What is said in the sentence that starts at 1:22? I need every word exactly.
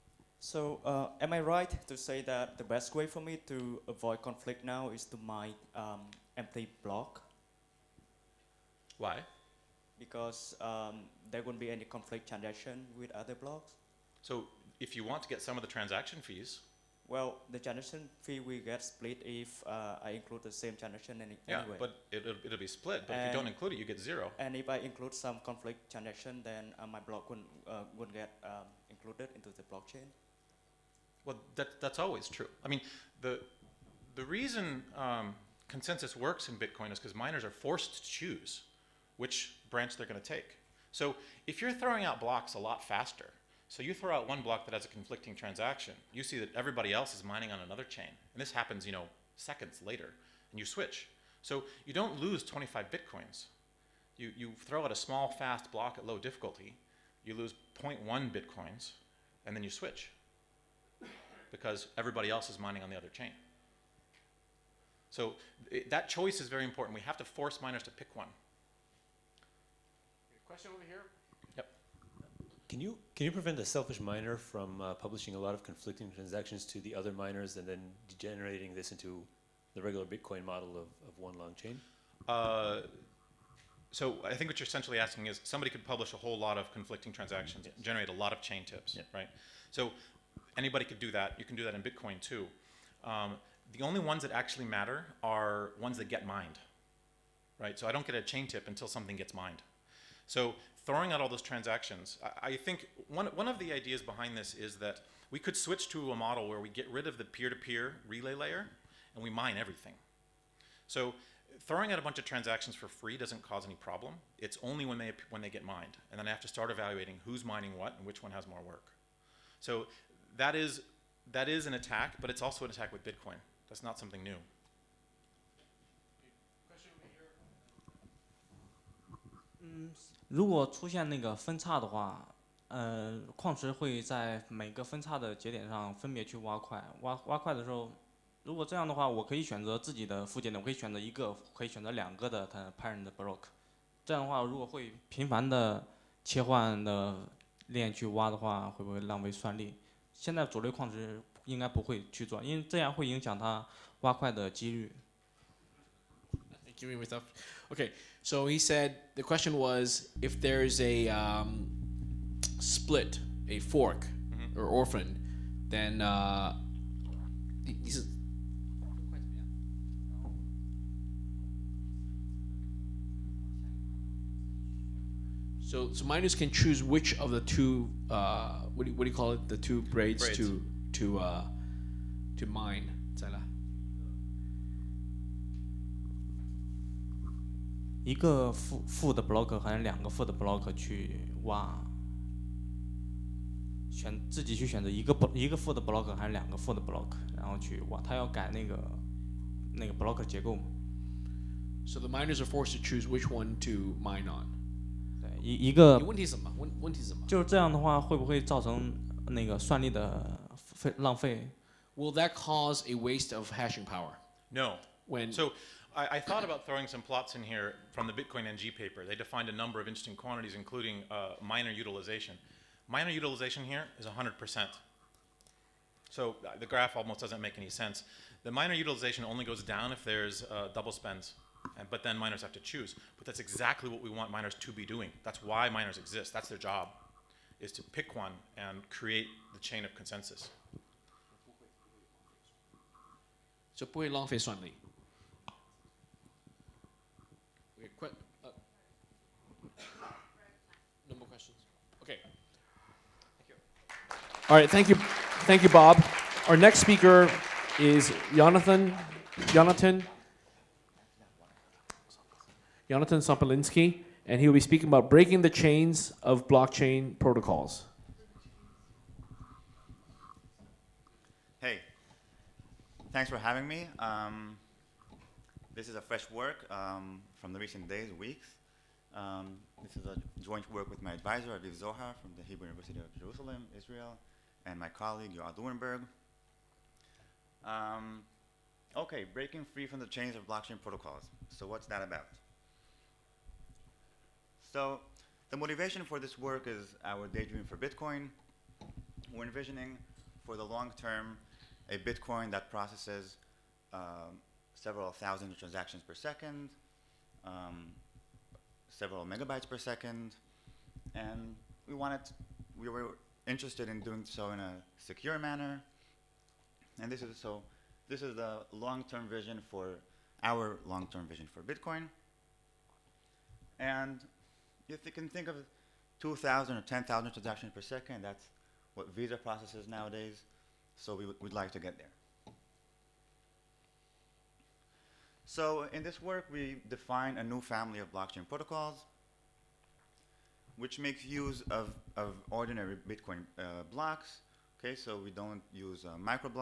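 Uh, so I think what you're essentially asking is somebody could publish a whole lot of conflicting transactions, yes.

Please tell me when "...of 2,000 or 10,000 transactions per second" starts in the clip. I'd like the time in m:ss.
5:25.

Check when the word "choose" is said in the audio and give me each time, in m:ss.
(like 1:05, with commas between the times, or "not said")
0:38, 2:56, 3:22, 3:52.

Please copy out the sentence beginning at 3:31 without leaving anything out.
Will that cause a waste of hashing power?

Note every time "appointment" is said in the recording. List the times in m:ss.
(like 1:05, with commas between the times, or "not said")
not said.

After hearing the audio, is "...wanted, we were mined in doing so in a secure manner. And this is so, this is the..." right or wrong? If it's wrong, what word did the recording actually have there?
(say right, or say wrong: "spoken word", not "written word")
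wrong: "interested", not "mined".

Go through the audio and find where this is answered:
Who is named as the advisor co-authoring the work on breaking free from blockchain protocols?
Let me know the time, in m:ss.
4:41.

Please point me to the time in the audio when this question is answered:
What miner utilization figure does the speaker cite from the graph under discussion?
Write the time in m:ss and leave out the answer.
3:44.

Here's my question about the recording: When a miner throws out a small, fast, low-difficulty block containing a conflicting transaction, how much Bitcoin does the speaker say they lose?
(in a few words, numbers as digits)
0.1 Bitcoins.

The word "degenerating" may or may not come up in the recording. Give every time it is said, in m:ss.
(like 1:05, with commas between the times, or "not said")
1:18.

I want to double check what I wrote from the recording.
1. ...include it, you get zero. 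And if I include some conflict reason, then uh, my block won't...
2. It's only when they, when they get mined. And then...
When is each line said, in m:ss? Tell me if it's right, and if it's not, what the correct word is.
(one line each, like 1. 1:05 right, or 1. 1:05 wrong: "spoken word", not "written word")
1. 0:23 wrong: "transaction", not "reason"
2. 1:54 right.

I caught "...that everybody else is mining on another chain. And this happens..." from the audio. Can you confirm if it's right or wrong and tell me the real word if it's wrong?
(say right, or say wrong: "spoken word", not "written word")
right.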